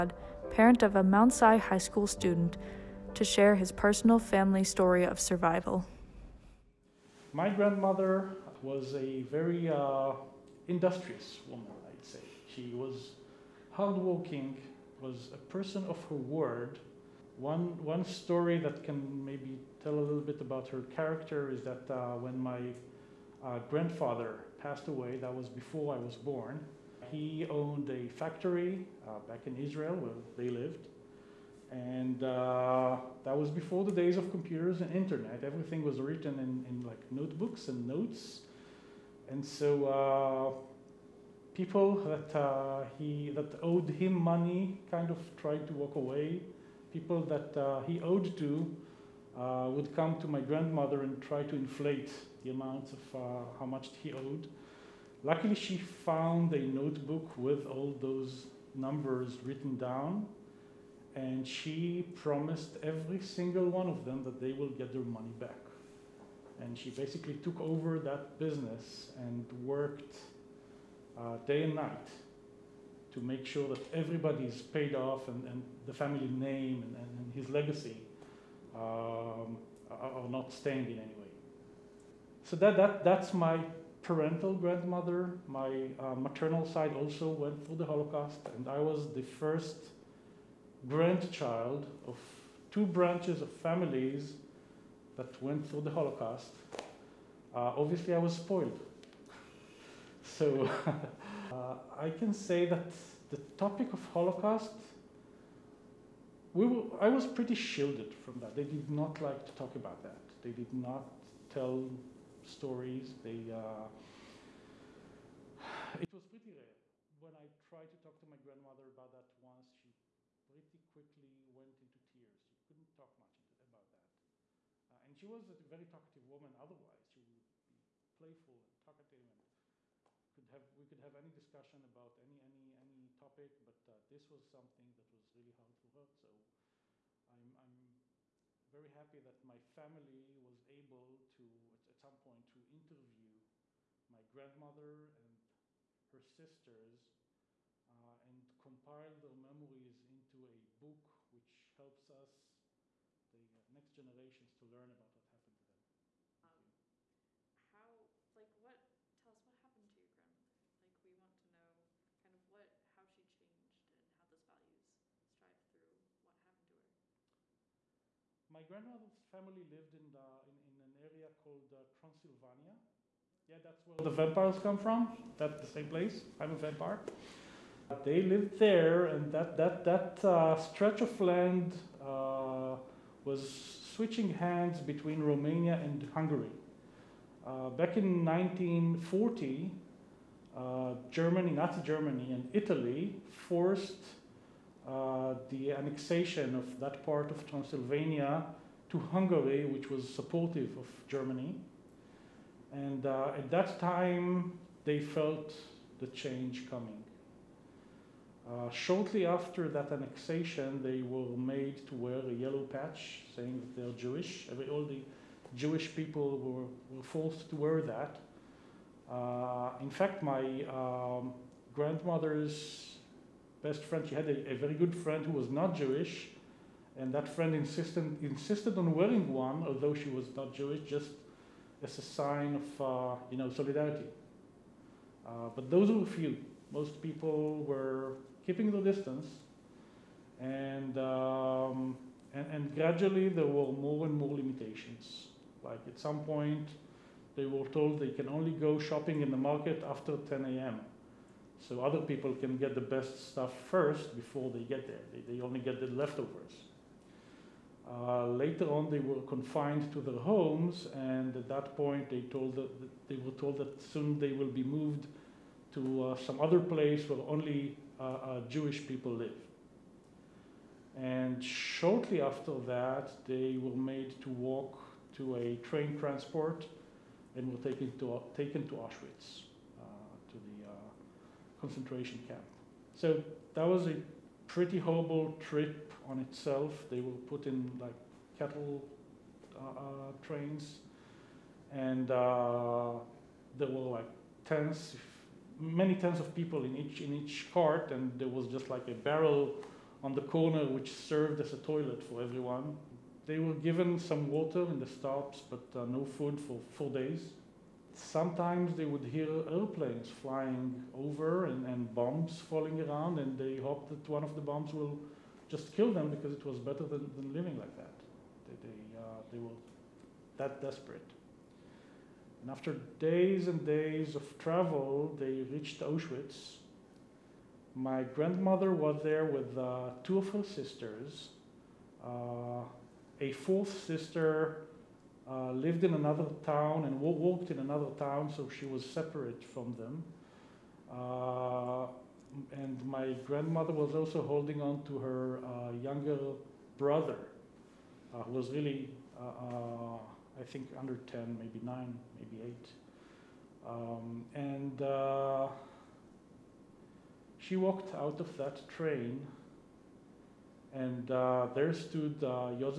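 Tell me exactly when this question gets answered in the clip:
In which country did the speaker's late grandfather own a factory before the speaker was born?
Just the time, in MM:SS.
00:29.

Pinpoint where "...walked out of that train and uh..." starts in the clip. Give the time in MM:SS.
05:57.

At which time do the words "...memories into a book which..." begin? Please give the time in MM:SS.
02:29.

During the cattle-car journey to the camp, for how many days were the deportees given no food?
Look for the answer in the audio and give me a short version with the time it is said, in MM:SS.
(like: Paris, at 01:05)
4 days, at 05:06.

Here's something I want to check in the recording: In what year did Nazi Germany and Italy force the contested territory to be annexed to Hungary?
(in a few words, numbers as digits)
1940.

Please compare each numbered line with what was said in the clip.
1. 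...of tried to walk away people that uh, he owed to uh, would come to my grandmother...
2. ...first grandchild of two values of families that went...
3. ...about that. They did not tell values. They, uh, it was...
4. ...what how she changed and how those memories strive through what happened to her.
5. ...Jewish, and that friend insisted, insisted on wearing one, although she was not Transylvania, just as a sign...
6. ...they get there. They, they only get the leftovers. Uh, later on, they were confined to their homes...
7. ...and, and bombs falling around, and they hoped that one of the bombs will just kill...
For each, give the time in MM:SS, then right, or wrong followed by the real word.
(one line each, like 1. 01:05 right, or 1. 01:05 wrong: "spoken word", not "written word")
1. 00:45 right
2. 01:29 wrong: "branches", not "values"
3. 01:49 wrong: "stories", not "values"
4. 02:42 wrong: "values", not "memories"
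5. 03:45 wrong: "Jewish", not "Transylvania"
6. 04:14 right
7. 05:11 right.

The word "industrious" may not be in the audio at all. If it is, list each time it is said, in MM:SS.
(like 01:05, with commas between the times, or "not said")
00:10.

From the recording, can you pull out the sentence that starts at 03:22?
And uh, at that time, they felt the change coming.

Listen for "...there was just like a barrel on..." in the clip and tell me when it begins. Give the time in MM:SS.
04:58.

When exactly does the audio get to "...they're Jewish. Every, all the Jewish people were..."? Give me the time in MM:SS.
03:33.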